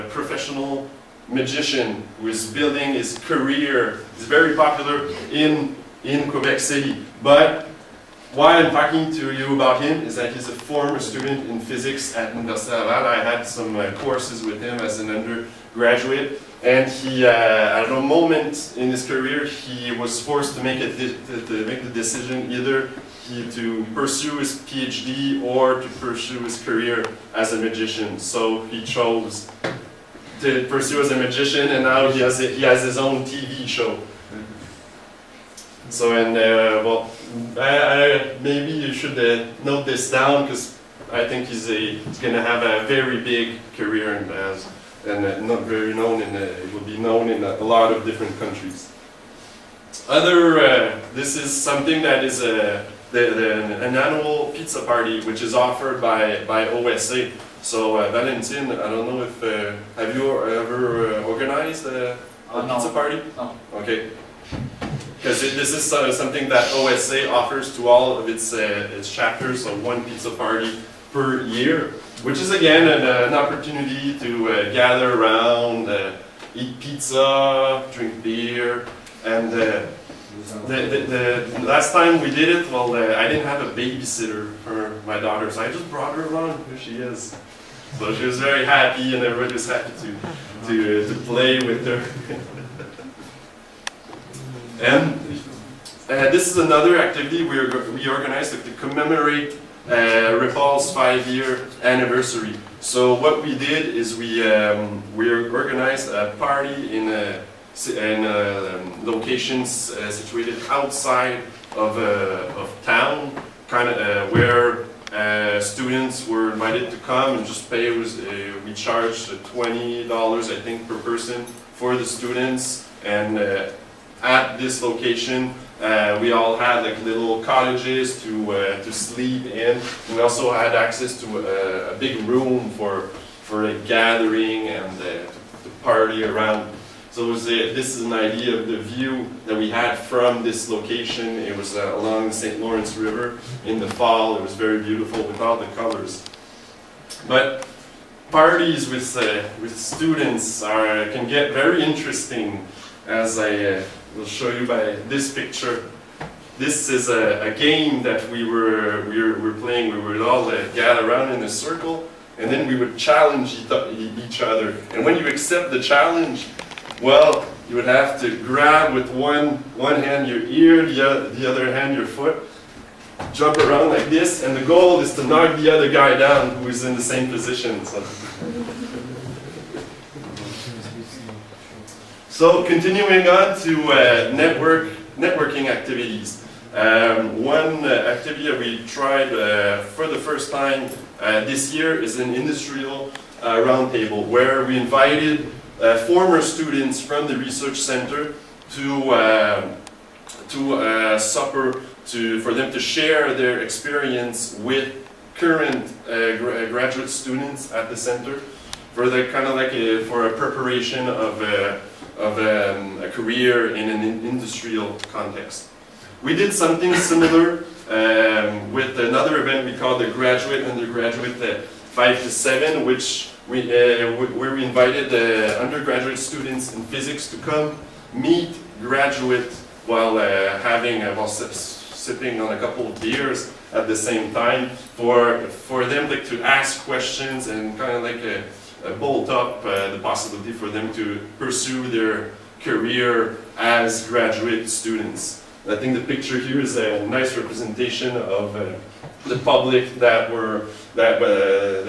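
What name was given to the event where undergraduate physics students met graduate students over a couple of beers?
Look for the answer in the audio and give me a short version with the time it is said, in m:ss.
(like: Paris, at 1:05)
Graduate Undergraduate 5 to 7, at 3:40.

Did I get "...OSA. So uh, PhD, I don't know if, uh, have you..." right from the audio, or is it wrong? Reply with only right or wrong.
wrong.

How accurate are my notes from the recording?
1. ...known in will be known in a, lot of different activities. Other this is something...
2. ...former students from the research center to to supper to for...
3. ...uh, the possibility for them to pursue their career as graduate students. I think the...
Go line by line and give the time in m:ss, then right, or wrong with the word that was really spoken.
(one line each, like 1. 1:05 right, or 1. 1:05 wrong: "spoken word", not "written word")
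1. 0:45 wrong: "countries", not "activities"
2. 3:16 right
3. 3:59 right.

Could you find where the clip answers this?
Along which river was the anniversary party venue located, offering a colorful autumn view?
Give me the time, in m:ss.
2:22.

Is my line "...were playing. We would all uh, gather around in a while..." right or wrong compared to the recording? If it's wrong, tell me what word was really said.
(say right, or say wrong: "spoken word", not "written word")
wrong: "circle", not "while".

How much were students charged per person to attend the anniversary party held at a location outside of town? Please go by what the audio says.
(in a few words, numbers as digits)
$20.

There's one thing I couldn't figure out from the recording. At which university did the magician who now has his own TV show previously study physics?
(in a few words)
Université Laval.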